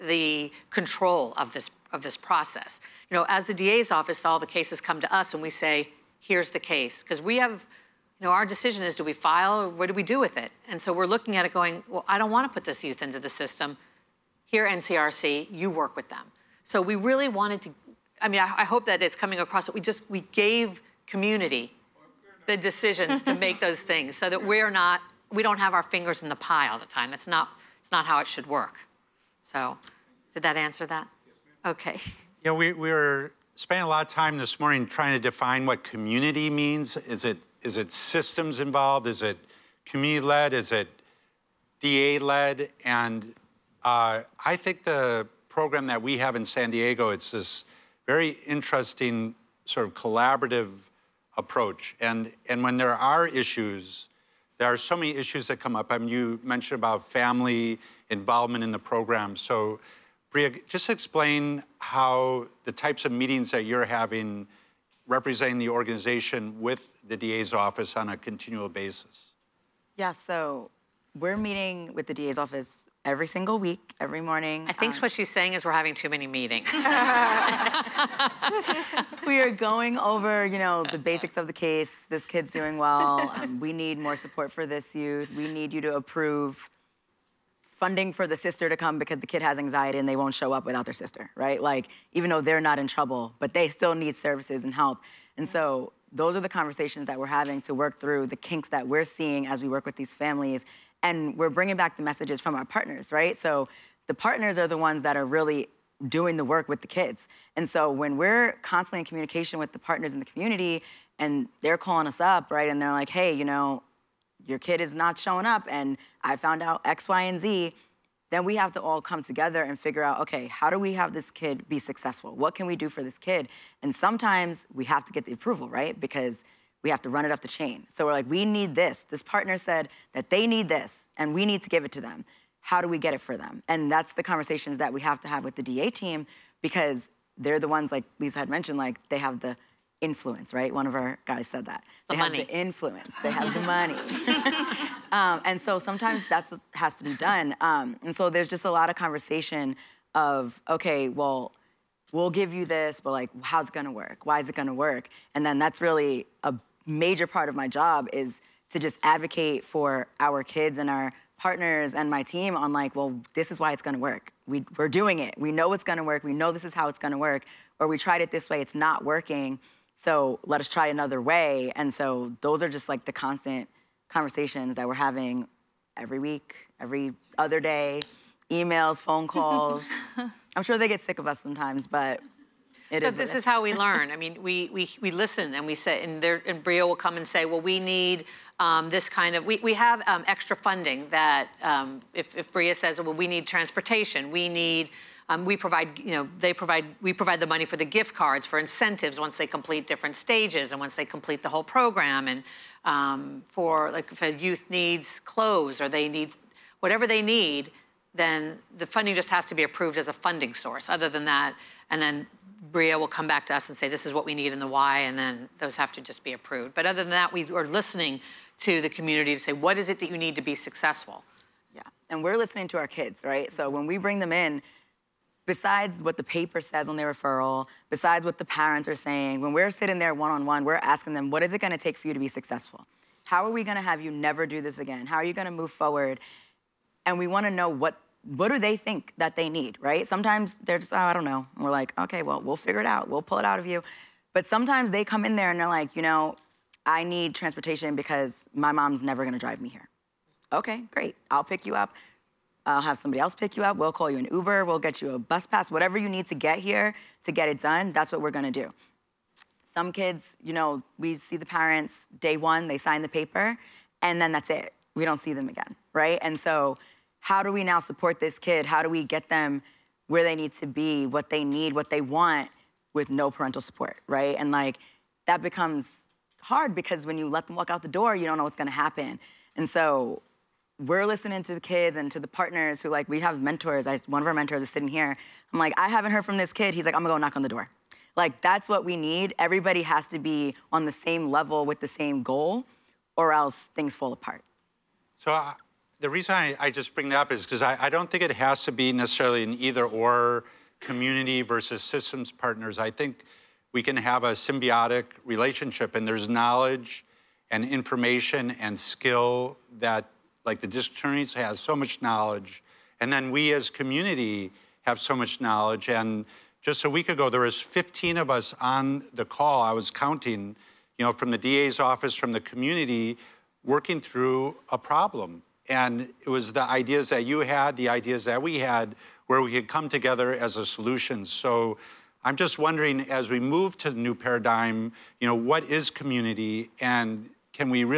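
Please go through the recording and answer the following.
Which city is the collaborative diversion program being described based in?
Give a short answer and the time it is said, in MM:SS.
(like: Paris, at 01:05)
San Diego, at 00:46.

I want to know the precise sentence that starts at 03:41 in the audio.
Yeah, and we're listening to our kids, right?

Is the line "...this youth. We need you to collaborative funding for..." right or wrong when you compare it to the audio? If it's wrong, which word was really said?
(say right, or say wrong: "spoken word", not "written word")
wrong: "approve", not "collaborative".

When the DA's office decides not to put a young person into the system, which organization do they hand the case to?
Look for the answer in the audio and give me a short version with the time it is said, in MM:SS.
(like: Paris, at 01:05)
NCRC, at 00:14.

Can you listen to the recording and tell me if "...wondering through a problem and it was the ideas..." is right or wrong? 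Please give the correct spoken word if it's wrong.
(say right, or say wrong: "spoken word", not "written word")
wrong: "working", not "wondering".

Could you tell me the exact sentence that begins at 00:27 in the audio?
That's not, it's not how it should work.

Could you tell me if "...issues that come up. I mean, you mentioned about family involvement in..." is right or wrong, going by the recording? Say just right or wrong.
right.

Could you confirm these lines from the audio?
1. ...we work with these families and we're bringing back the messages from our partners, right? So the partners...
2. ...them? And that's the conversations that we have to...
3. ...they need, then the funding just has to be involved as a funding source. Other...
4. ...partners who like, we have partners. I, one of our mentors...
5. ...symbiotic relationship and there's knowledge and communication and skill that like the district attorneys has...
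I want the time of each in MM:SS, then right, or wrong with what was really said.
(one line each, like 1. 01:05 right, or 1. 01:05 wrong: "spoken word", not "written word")
1. 01:39 right
2. 02:13 right
3. 03:27 wrong: "approved", not "involved"
4. 04:42 wrong: "mentors", not "partners"
5. 05:04 wrong: "information", not "communication".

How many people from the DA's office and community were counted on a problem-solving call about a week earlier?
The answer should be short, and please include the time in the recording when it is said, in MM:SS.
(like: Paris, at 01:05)
15, at 05:17.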